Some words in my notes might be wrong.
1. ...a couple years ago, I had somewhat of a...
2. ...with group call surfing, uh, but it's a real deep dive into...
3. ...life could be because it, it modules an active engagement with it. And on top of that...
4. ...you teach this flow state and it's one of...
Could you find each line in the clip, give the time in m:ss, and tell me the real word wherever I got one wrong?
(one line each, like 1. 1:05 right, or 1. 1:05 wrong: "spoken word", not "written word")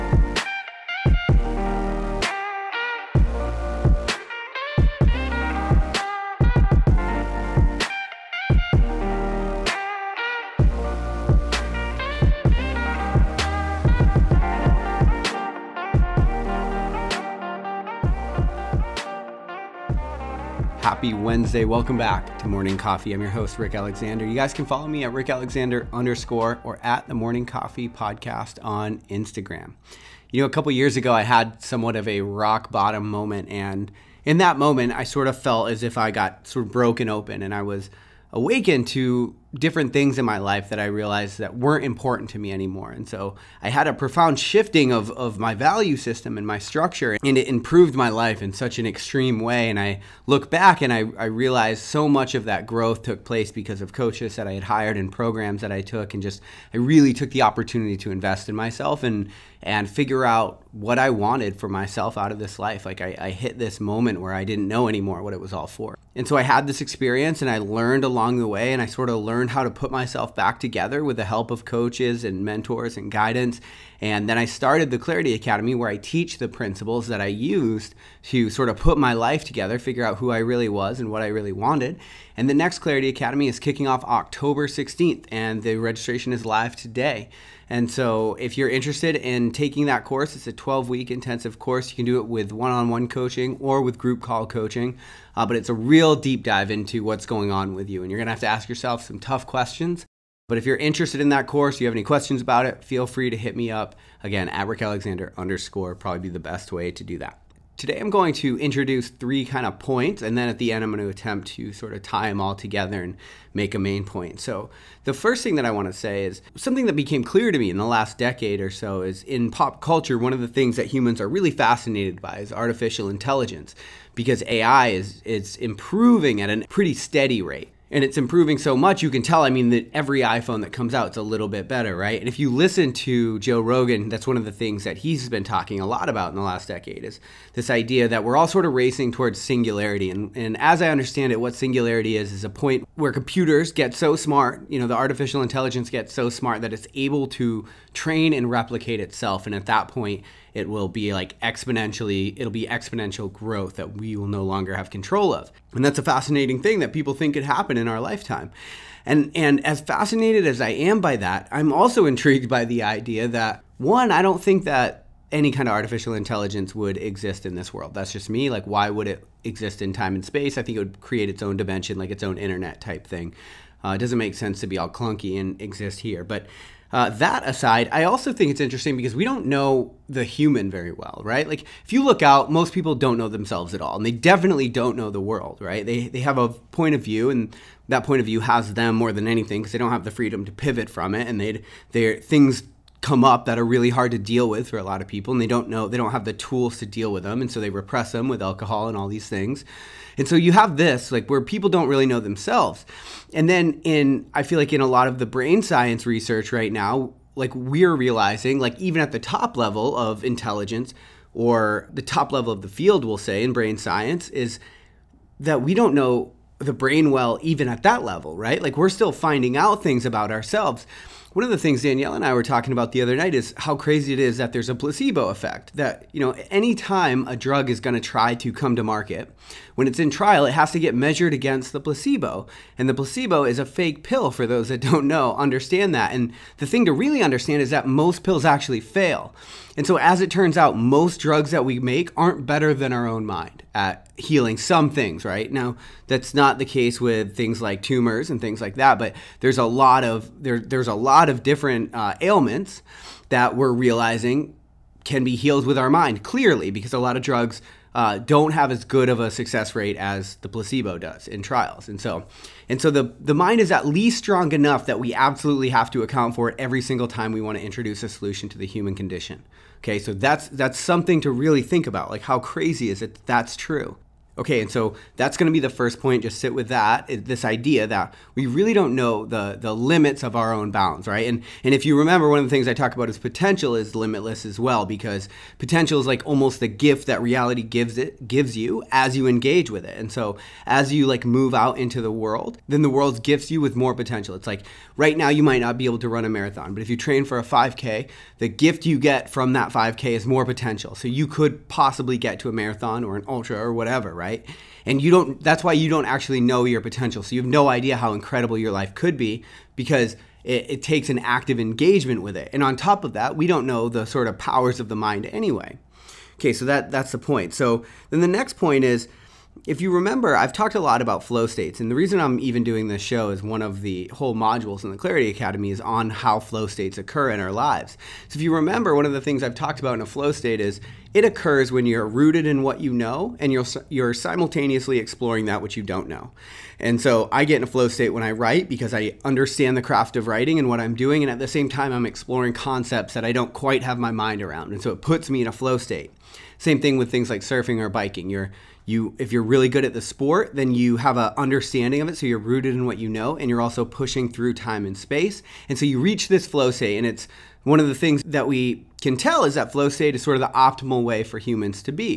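1. 0:30 right
2. 1:33 wrong: "coaching", not "surfing"
3. 5:08 wrong: "takes", not "modules"
4. 5:55 wrong: "reach", not "teach".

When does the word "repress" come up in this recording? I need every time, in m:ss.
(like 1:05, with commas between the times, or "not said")
3:17.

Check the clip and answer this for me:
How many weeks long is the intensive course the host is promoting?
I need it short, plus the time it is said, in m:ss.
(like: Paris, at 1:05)
12, at 1:30.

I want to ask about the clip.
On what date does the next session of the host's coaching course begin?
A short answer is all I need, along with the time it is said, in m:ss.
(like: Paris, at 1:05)
October 16th, at 1:24.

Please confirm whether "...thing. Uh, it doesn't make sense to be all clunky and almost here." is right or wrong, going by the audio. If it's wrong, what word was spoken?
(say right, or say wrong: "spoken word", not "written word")
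wrong: "exist", not "almost".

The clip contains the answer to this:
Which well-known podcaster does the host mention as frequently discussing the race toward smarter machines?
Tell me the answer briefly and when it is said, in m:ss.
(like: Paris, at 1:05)
Joe Rogan, at 2:13.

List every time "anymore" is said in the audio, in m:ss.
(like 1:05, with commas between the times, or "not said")
0:42, 1:04.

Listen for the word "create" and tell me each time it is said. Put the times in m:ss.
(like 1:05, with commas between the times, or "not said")
2:51.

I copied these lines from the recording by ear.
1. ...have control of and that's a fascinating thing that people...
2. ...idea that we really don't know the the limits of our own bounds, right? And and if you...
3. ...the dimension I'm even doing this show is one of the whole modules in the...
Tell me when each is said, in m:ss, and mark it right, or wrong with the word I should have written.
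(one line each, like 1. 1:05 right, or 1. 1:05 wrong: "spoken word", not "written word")
1. 2:34 right
2. 4:37 right
3. 5:21 wrong: "reason", not "dimension".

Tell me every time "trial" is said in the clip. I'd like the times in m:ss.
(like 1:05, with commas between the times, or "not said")
3:50, 4:21.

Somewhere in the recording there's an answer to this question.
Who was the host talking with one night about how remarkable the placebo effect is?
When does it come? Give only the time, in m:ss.
3:41.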